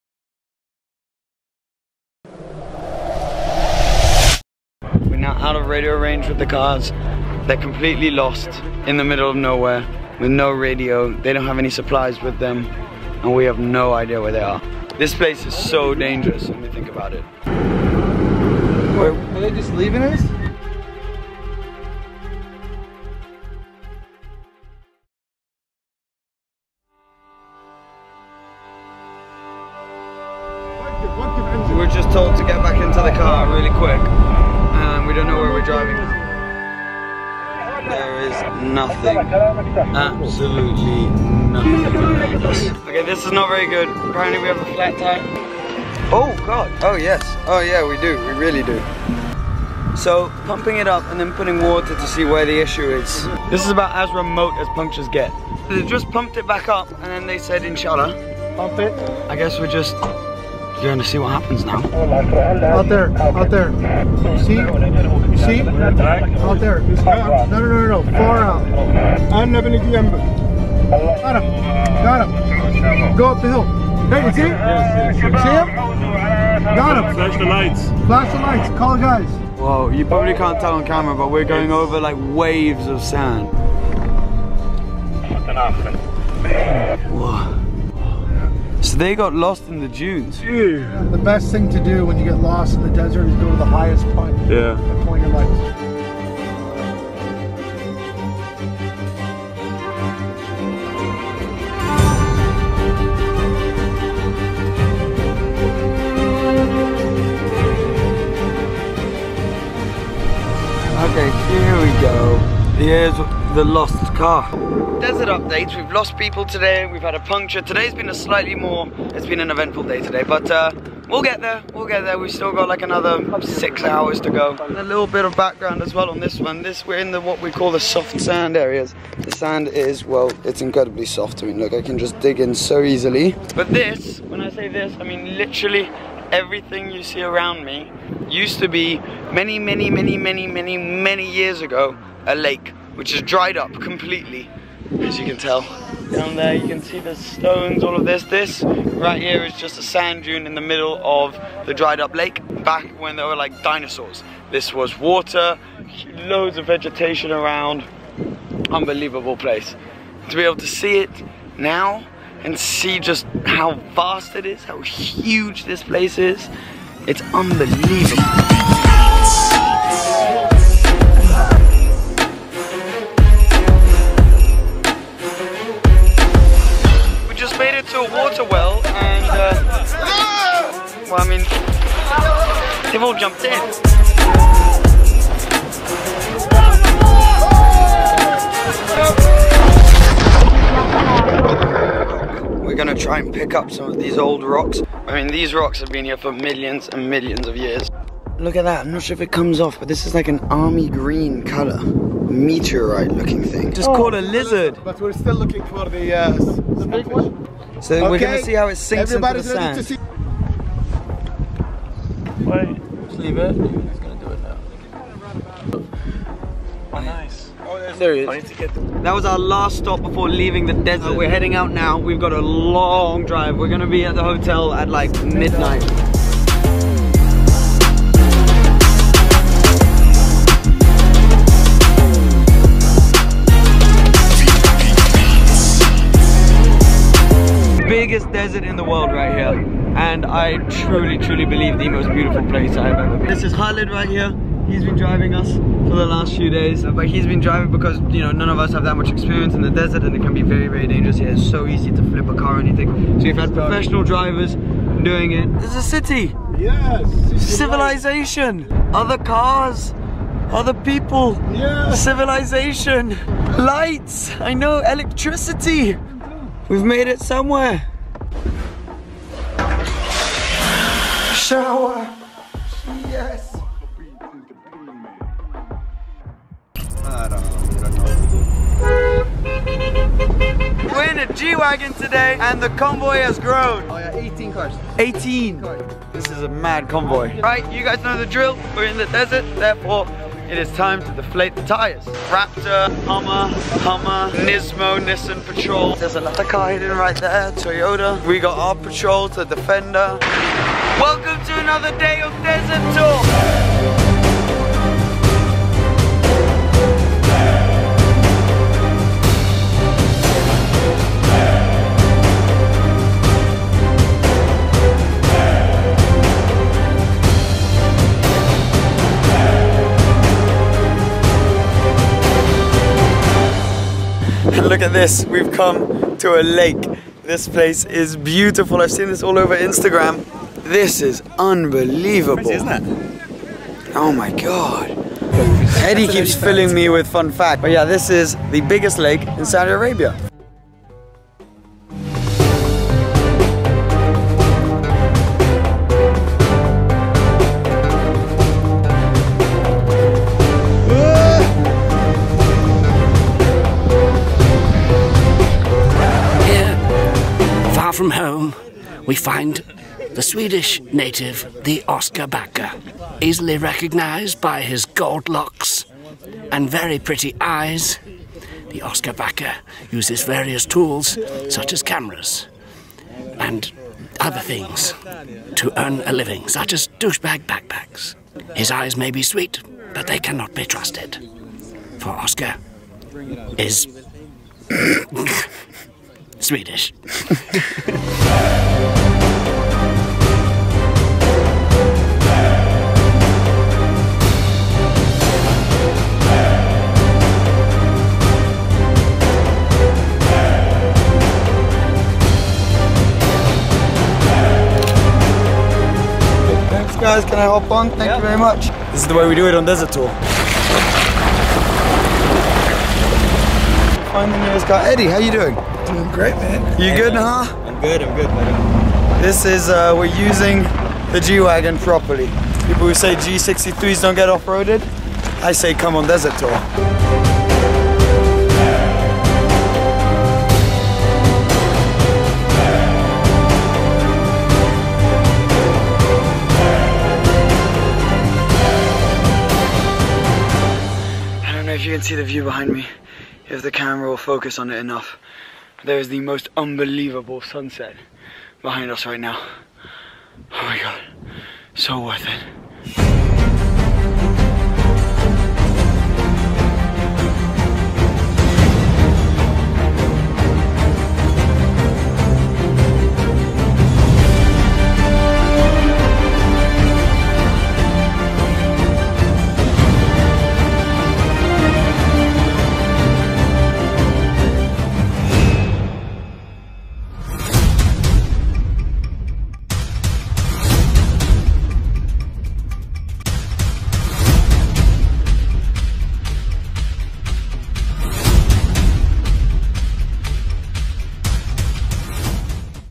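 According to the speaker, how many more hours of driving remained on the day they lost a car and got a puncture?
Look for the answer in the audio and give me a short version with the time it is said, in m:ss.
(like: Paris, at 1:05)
6, at 2:03.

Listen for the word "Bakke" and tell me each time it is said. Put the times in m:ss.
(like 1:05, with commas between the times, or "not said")
6:02, 6:09.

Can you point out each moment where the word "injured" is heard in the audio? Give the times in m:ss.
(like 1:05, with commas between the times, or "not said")
not said.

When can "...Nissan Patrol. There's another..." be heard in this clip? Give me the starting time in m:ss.
4:55.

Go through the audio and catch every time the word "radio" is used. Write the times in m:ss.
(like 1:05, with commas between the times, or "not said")
0:05, 0:10.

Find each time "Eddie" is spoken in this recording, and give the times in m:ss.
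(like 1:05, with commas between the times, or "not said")
5:35, 6:54.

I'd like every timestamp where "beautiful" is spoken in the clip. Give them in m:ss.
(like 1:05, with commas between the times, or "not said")
4:02, 5:28.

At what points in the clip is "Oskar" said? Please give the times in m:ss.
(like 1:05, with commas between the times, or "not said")
6:01, 6:08, 6:22.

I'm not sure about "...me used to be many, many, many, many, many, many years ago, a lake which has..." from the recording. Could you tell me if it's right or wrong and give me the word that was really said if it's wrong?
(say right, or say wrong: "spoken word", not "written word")
right.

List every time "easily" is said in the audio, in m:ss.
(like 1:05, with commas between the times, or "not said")
2:12, 6:03.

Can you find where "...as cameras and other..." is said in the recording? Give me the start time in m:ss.
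6:11.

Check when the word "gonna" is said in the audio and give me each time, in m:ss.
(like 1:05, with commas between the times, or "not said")
3:12, 3:28, 3:33, 3:43.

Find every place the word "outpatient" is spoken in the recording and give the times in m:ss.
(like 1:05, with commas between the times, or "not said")
not said.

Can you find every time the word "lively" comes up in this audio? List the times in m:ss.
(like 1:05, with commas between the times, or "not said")
not said.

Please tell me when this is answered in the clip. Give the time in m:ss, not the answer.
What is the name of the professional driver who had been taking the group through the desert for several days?
4:03.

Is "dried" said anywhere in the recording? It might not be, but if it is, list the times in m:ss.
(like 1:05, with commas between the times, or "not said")
2:23, 2:31.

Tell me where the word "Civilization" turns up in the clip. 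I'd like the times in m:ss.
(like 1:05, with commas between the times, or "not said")
4:17, 4:21.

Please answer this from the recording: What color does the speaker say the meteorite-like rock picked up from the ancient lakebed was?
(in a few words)
army green.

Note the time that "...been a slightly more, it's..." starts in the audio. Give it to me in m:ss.
1:57.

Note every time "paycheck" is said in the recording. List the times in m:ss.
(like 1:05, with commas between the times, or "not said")
not said.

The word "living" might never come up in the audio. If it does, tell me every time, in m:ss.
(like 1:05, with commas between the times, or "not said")
6:16.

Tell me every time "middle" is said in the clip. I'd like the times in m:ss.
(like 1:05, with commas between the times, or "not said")
0:09, 2:30.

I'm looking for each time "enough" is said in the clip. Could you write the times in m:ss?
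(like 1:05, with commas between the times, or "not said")
7:24.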